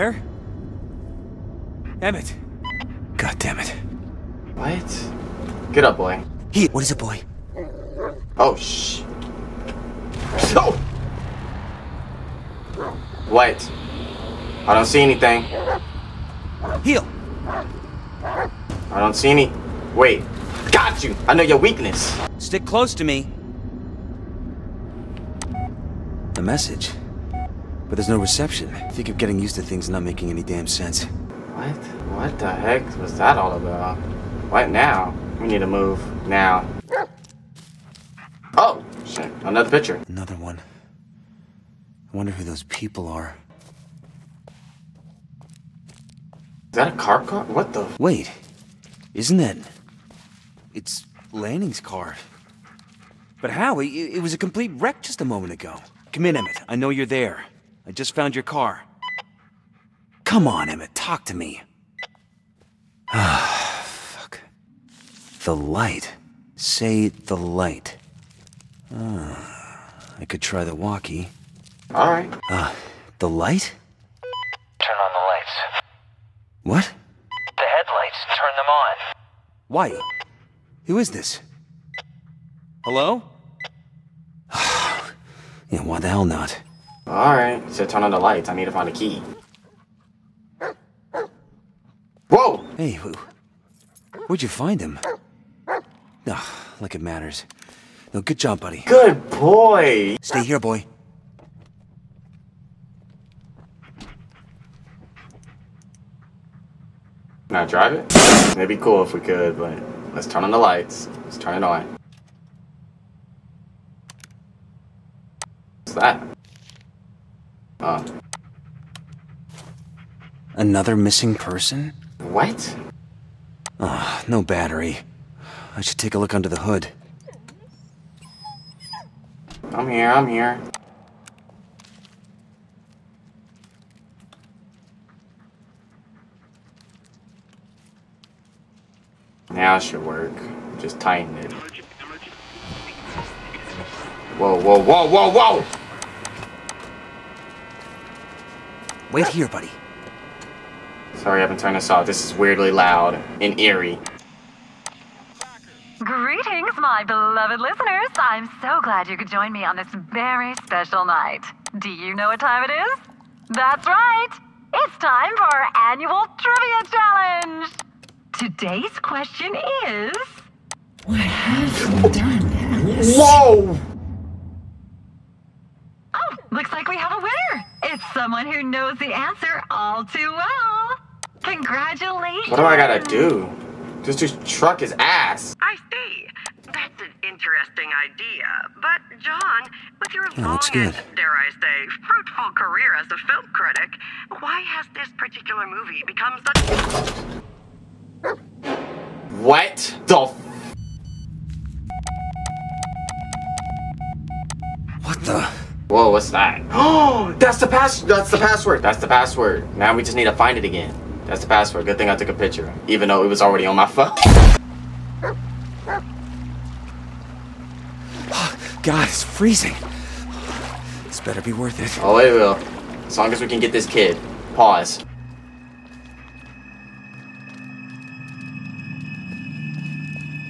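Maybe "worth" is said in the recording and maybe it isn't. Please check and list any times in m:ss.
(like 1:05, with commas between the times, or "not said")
3:41.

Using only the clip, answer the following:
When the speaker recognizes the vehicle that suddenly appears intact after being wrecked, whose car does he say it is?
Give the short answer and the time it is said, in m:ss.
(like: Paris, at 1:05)
Lanning's car, at 0:51.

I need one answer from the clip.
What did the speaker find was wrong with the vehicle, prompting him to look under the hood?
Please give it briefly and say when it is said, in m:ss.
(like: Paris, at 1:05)
No battery, at 2:04.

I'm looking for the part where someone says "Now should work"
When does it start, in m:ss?
2:19.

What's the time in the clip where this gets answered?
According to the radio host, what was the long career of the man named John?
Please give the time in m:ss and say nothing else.
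3:13.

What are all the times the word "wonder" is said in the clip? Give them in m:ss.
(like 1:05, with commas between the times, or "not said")
0:42.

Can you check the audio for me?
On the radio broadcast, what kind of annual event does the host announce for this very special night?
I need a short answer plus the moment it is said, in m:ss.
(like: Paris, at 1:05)
Trivia challenge, at 2:46.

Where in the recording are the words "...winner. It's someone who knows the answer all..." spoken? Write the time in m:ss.
2:57.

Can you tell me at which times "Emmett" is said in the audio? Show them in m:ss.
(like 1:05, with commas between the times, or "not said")
0:02, 0:56, 1:00.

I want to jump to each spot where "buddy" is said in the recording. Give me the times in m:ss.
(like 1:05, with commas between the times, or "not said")
1:38, 2:29.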